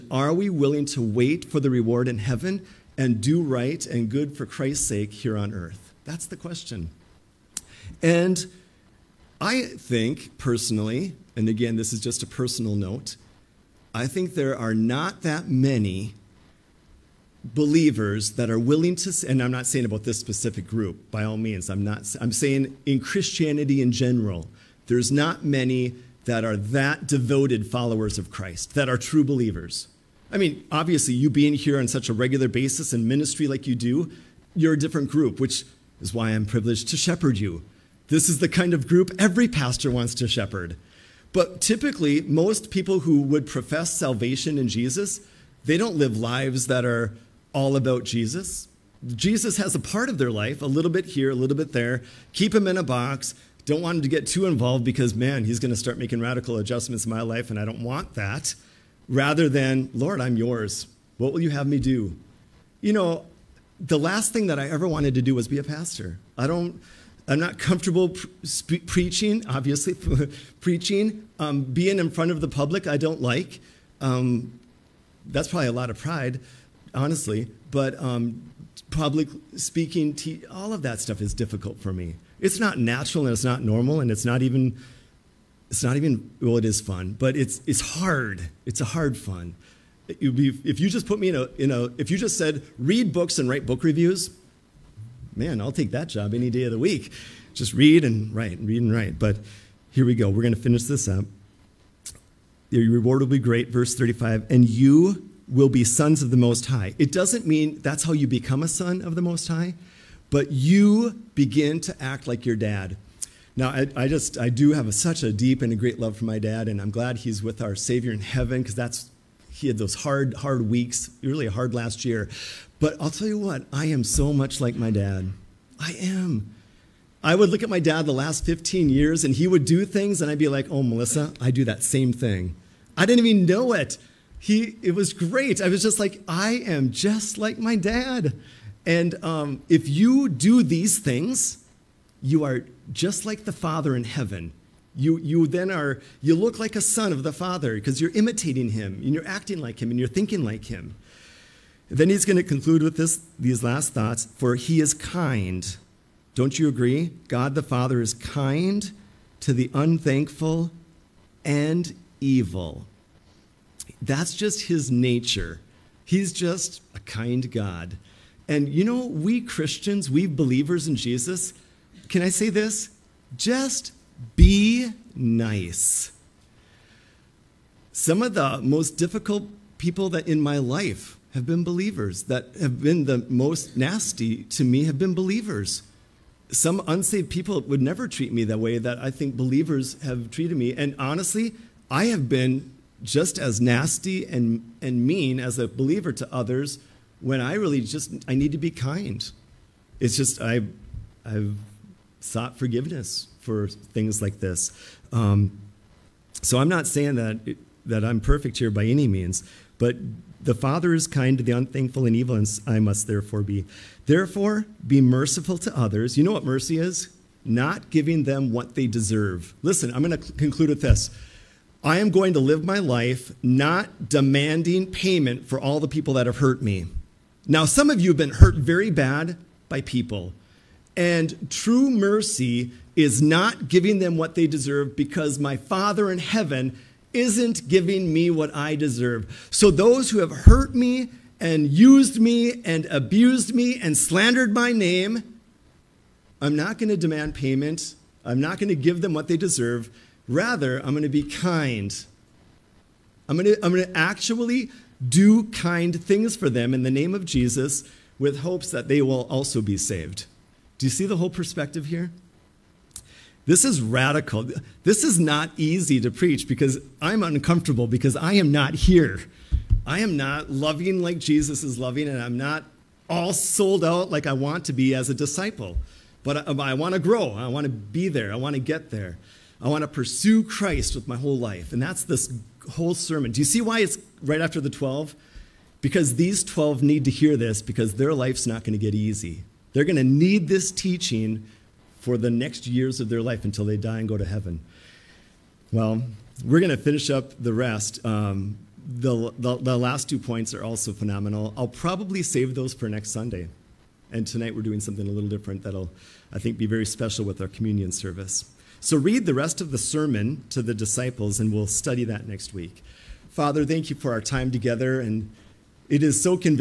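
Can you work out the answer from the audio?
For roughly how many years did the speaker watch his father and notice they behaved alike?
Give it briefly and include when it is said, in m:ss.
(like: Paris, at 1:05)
15, at 2:08.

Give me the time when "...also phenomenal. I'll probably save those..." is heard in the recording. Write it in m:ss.
5:00.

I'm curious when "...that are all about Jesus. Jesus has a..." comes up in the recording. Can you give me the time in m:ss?
0:46.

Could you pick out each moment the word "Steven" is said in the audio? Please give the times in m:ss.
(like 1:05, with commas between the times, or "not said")
not said.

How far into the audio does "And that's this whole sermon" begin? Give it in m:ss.
4:41.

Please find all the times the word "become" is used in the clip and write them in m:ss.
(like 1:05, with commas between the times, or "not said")
1:48.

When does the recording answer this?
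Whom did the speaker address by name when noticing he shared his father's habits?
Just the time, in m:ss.
2:10.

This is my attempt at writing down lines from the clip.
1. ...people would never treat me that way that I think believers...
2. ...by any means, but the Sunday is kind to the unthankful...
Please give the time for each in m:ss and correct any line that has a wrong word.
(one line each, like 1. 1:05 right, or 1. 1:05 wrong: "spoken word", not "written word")
1. 3:07 right
2. 3:28 wrong: "Father", not "Sunday".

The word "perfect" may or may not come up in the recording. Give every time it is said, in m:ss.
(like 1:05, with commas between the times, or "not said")
3:28.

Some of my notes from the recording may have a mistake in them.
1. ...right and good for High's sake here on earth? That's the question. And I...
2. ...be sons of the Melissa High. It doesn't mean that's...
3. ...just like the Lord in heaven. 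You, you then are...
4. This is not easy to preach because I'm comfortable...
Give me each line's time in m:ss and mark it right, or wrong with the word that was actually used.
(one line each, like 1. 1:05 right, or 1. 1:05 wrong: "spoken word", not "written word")
1. 0:03 wrong: "Christ", not "High"
2. 1:45 wrong: "Most", not "Melissa"
3. 2:22 wrong: "Father", not "Lord"
4. 4:24 wrong: "uncomfortable", not "comfortable".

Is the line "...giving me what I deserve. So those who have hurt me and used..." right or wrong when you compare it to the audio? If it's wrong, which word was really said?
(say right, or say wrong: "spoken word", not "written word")
right.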